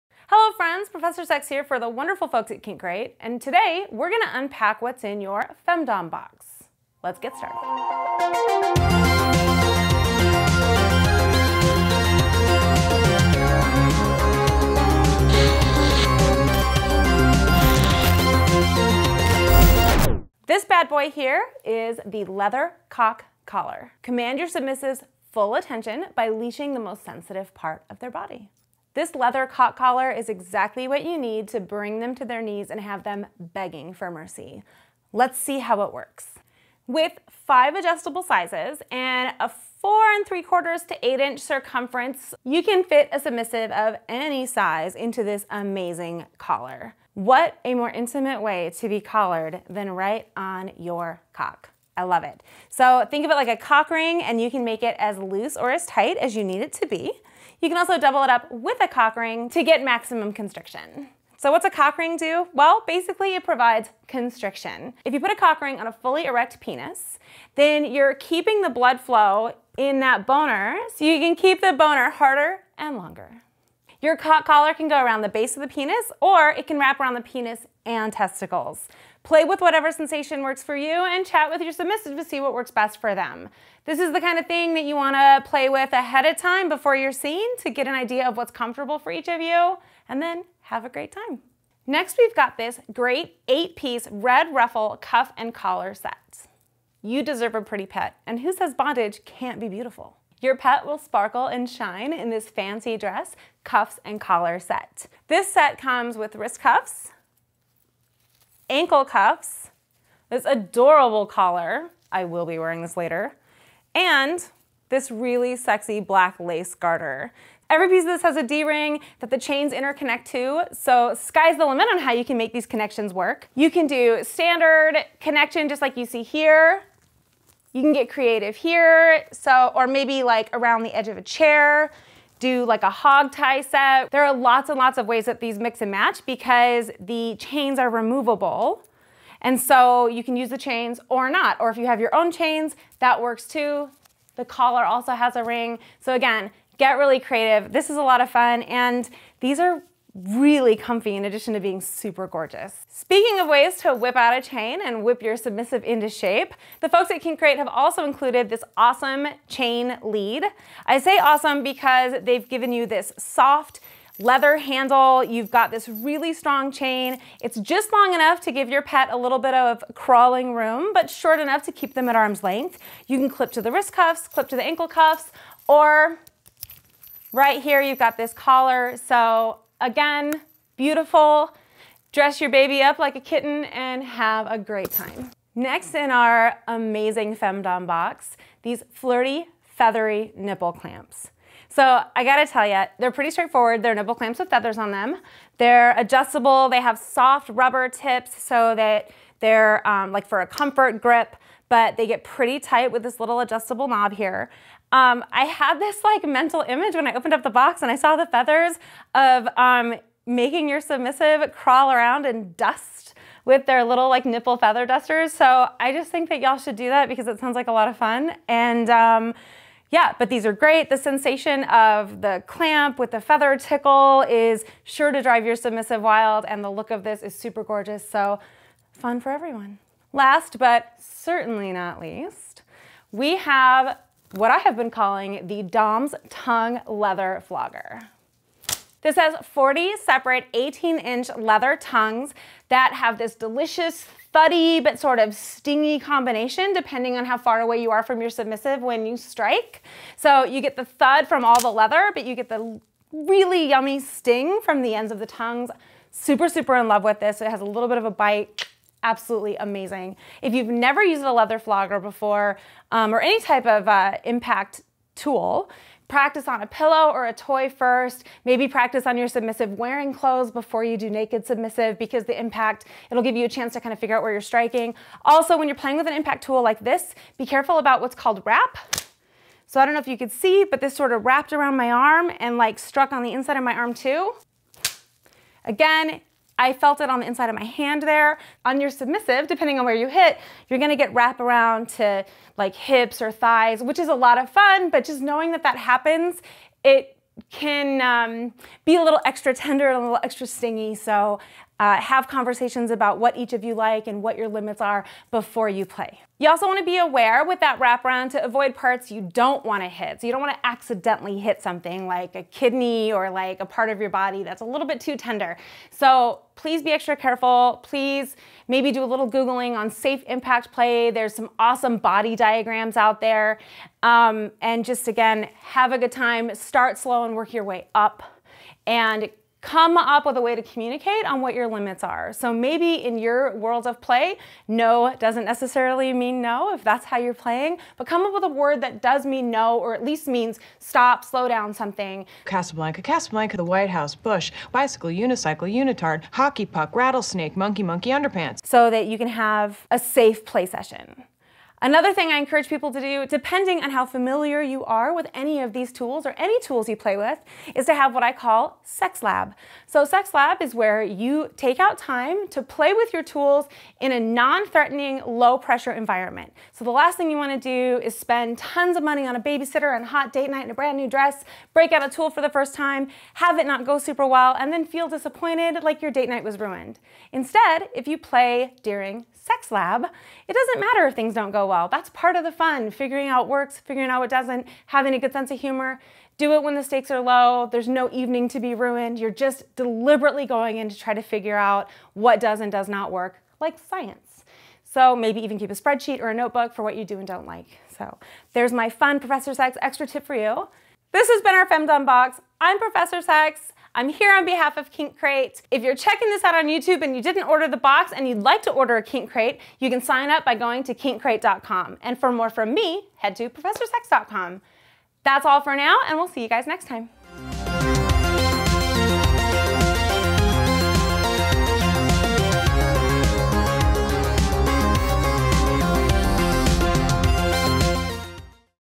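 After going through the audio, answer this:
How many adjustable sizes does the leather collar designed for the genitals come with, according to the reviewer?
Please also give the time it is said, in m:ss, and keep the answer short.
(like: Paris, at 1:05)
5, at 0:37.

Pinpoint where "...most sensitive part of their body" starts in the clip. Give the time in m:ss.
0:26.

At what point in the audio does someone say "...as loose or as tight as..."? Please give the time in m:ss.
0:54.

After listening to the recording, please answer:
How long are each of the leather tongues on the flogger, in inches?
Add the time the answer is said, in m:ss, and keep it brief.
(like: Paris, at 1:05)
18 inches, at 4:00.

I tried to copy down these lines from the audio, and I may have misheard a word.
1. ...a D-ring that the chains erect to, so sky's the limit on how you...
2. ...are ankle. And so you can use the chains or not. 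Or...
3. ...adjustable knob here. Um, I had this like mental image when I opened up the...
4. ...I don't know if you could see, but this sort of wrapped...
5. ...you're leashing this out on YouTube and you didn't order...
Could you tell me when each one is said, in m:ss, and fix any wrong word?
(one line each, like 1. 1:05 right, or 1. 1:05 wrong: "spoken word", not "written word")
1. 1:58 wrong: "interconnect", not "erect"
2. 2:17 wrong: "removable", not "ankle"
3. 3:23 right
4. 4:39 right
5. 6:45 wrong: "checking", not "leashing".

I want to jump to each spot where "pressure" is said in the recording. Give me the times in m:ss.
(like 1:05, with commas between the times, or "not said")
6:05.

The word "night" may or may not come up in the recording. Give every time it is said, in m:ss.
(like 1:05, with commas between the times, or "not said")
6:10, 6:16.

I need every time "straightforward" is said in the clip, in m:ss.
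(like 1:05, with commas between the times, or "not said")
3:13.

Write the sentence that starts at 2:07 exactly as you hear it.
You can get creative here, so or maybe like around the edge of a chair do like a hog tie set.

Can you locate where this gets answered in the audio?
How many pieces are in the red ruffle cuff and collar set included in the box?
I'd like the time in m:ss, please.
1:33.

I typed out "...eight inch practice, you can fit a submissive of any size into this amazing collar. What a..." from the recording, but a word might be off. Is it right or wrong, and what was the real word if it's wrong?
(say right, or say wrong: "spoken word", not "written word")
wrong: "circumference", not "practice".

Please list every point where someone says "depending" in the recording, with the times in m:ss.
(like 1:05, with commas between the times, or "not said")
4:06, 4:49, 5:53.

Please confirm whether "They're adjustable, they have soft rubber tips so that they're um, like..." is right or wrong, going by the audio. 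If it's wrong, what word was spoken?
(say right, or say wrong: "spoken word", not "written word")
right.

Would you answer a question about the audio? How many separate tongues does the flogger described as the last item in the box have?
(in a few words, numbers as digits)
40.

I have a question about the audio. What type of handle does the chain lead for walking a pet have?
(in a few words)
Soft leather.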